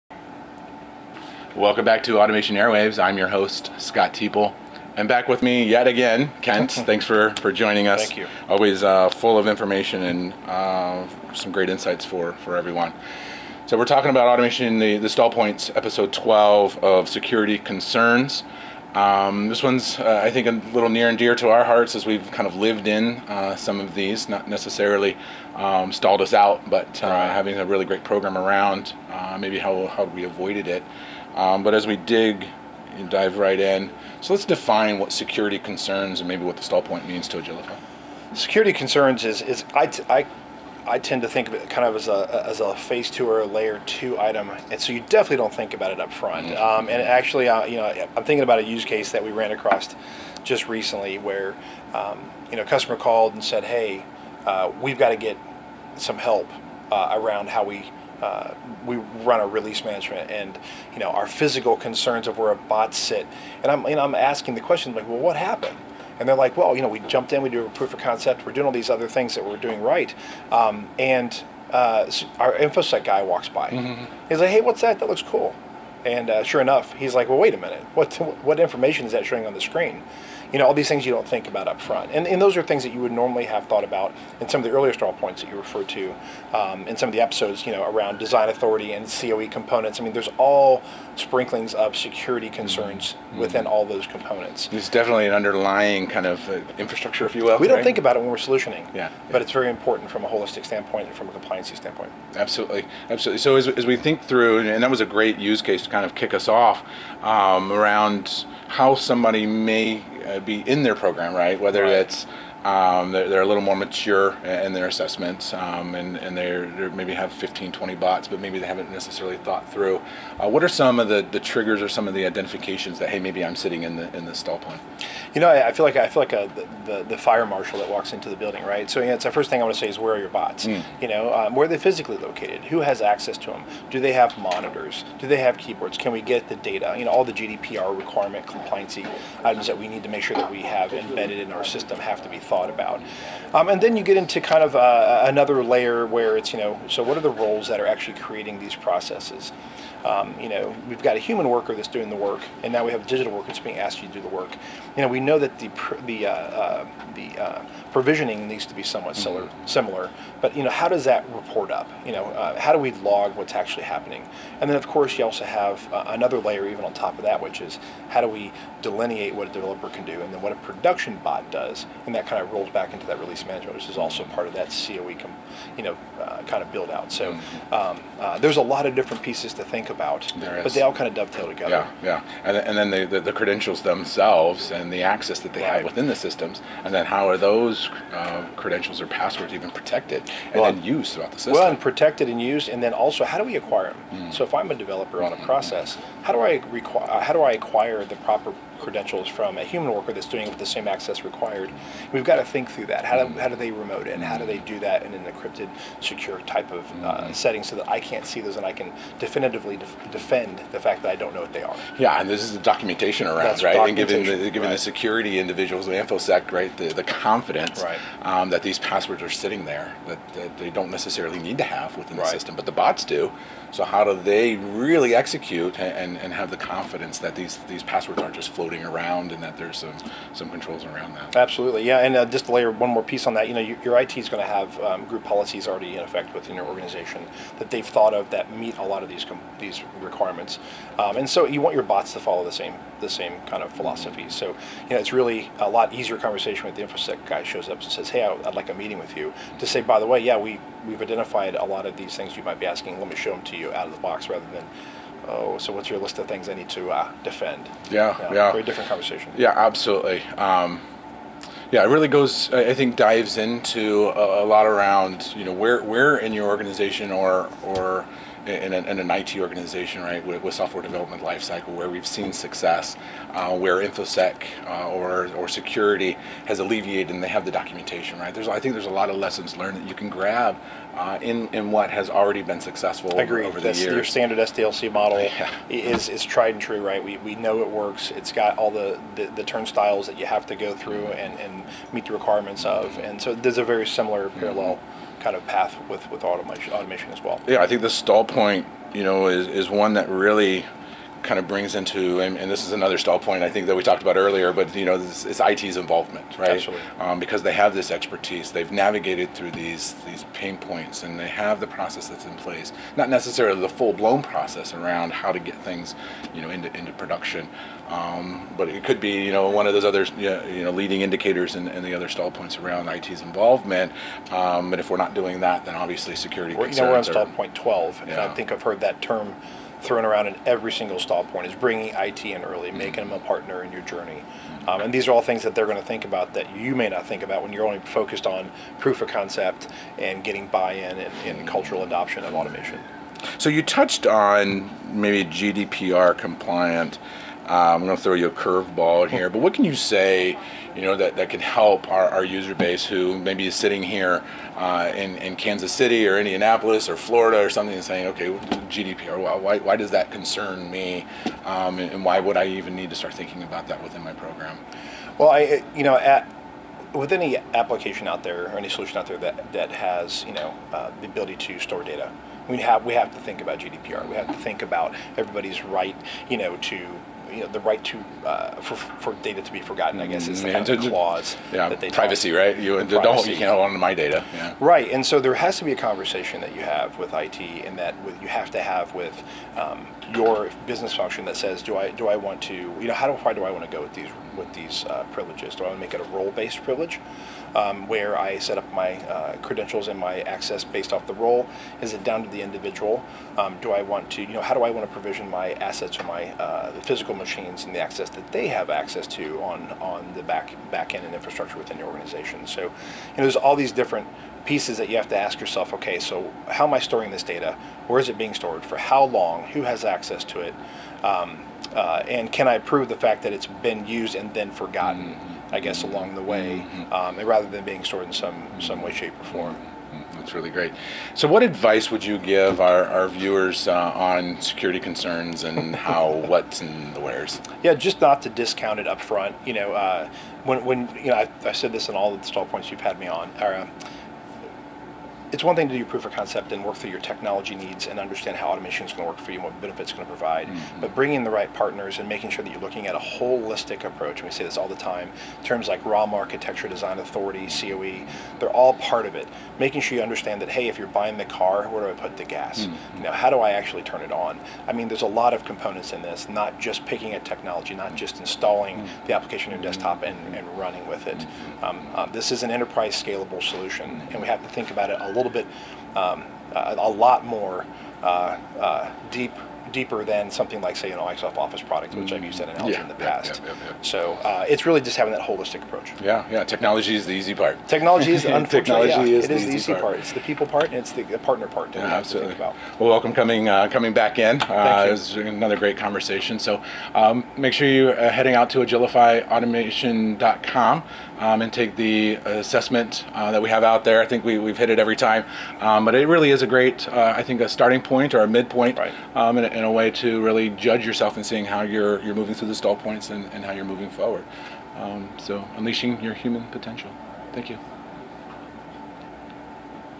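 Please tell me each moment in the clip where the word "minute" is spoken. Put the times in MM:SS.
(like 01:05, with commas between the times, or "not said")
01:17.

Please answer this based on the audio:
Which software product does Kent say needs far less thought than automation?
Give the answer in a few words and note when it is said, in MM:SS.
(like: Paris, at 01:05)
Microsoft Office, at 08:00.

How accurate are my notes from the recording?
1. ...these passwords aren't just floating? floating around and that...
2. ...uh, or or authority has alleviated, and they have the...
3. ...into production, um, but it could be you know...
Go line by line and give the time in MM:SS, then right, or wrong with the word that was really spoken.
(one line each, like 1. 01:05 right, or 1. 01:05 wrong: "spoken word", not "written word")
1. 03:47 right
2. 04:34 wrong: "security", not "authority"
3. 05:16 right.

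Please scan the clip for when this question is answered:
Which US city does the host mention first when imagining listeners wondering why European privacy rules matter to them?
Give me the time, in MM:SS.
05:55.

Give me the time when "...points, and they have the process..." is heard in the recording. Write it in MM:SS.
05:10.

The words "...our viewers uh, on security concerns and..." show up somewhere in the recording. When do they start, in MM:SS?
07:12.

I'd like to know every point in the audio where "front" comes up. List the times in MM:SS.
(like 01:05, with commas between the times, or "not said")
00:46, 01:21, 07:19.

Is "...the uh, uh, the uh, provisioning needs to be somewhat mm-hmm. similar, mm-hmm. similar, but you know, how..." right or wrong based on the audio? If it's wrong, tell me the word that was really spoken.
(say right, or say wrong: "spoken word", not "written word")
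right.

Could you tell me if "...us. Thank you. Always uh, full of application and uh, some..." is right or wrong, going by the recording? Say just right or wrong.
wrong.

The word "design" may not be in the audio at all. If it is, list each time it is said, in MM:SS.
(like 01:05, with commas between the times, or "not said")
01:28, 07:36.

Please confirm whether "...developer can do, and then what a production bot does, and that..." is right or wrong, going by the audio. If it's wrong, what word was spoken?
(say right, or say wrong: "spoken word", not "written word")
right.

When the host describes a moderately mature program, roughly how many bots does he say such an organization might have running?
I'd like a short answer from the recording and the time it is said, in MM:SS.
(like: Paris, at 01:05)
15 to 20, at 01:57.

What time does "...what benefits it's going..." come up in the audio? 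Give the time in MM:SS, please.
07:29.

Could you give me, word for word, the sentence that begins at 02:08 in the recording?
So yeah, it's the first thing I want to say is where are your bots?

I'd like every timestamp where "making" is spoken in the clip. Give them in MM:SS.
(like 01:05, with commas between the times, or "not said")
05:32, 07:32, 07:39.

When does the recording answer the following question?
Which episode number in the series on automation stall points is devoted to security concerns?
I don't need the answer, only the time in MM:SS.
00:15.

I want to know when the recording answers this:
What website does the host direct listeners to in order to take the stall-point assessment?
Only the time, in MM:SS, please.
08:18.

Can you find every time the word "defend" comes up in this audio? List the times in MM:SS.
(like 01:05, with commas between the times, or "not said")
03:30, 04:17.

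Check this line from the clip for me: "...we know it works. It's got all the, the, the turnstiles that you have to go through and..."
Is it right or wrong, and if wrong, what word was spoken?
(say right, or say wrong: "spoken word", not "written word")
right.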